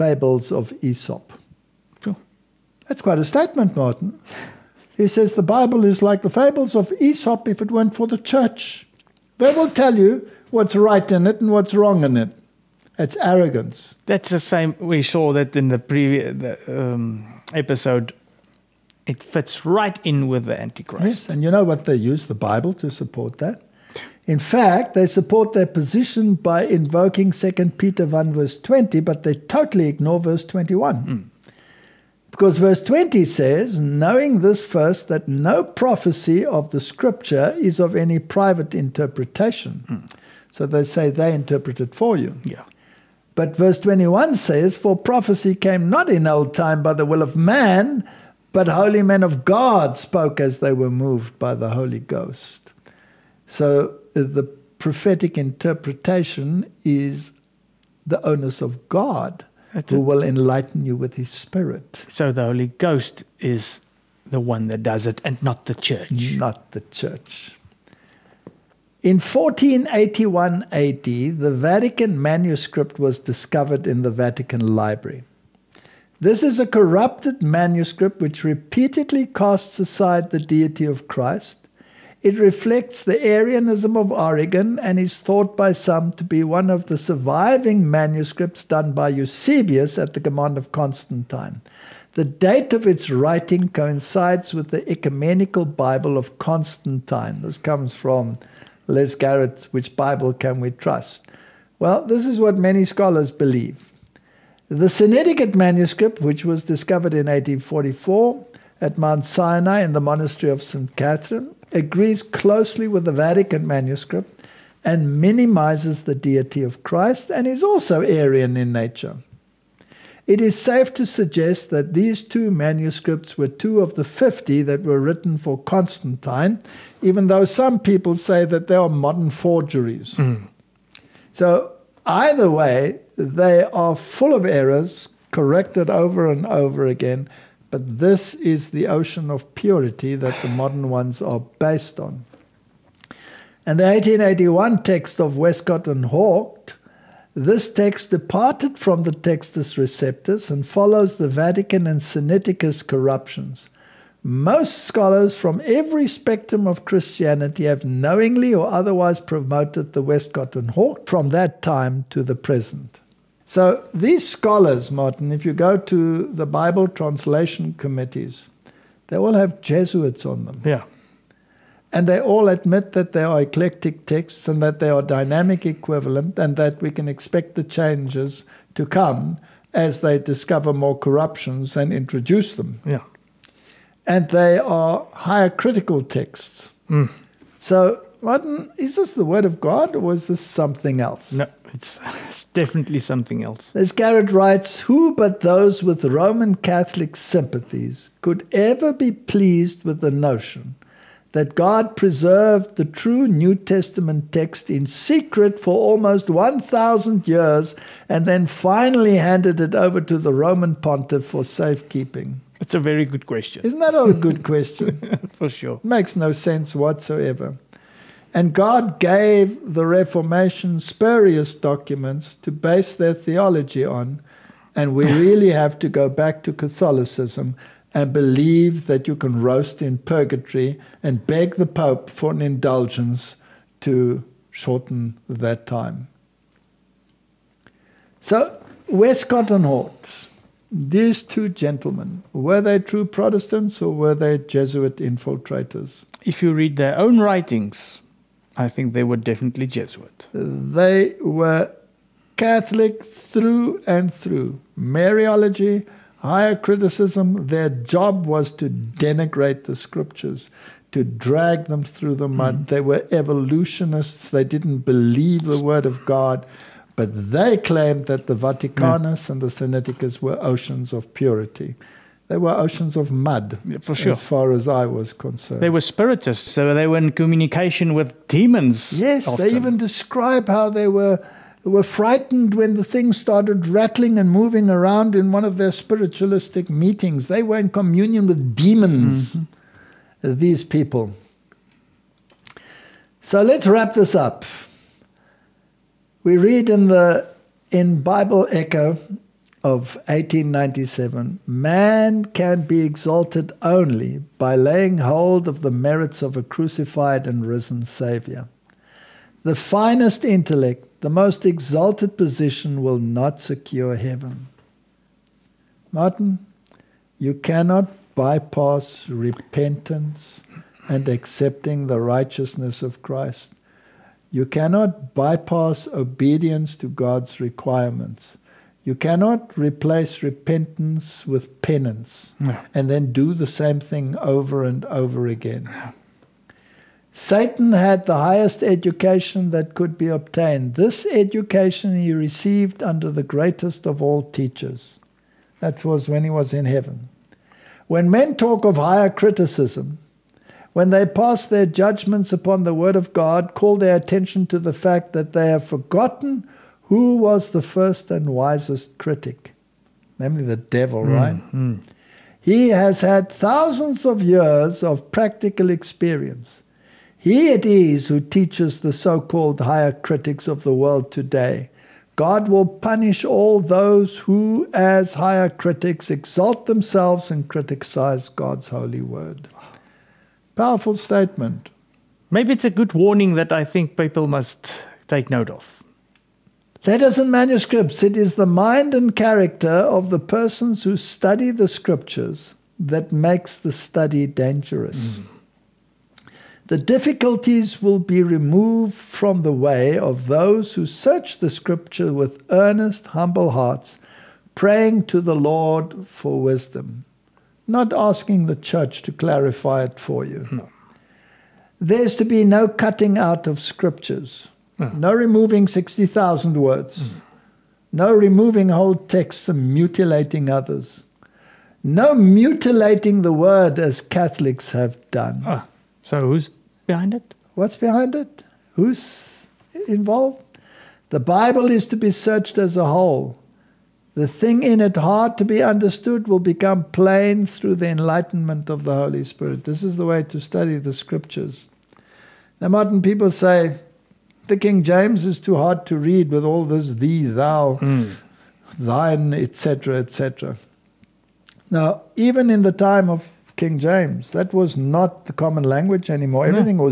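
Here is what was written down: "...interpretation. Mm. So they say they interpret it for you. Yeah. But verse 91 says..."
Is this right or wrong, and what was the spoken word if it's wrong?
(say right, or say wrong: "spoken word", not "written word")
wrong: "21", not "91".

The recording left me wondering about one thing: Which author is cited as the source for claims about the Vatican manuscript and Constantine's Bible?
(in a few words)
Les Garrett.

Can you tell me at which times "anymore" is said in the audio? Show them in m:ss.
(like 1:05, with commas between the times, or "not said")
7:36.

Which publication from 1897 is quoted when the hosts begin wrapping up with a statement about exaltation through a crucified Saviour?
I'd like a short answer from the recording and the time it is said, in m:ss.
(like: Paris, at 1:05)
Bible Echo, at 4:58.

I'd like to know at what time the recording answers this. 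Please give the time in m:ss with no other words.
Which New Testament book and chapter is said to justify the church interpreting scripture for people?
0:27.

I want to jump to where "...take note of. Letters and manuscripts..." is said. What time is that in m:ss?
6:25.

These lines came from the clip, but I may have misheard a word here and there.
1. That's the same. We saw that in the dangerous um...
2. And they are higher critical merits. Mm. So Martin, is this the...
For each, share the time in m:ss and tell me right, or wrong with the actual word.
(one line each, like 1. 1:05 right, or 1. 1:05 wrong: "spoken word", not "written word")
1. 0:14 wrong: "previous", not "dangerous"
2. 3:04 wrong: "texts", not "merits".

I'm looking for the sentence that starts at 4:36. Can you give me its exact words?
So they were in communication with demons.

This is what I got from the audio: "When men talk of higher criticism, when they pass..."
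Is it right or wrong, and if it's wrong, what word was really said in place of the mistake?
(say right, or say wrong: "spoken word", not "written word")
right.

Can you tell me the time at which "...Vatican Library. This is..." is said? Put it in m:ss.
1:14.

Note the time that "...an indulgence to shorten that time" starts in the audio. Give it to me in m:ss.
3:52.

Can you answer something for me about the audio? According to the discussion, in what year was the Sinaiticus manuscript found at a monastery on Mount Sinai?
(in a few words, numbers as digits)
1844.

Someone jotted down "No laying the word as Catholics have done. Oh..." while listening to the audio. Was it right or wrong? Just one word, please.
wrong.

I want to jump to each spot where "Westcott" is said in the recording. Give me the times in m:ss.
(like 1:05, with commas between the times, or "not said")
2:25, 2:40, 3:58.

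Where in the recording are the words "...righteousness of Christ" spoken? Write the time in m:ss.
5:21.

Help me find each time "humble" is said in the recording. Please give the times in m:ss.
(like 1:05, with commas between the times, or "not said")
6:43.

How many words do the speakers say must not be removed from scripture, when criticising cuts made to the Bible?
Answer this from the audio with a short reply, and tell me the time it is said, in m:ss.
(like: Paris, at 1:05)
60,000, at 6:55.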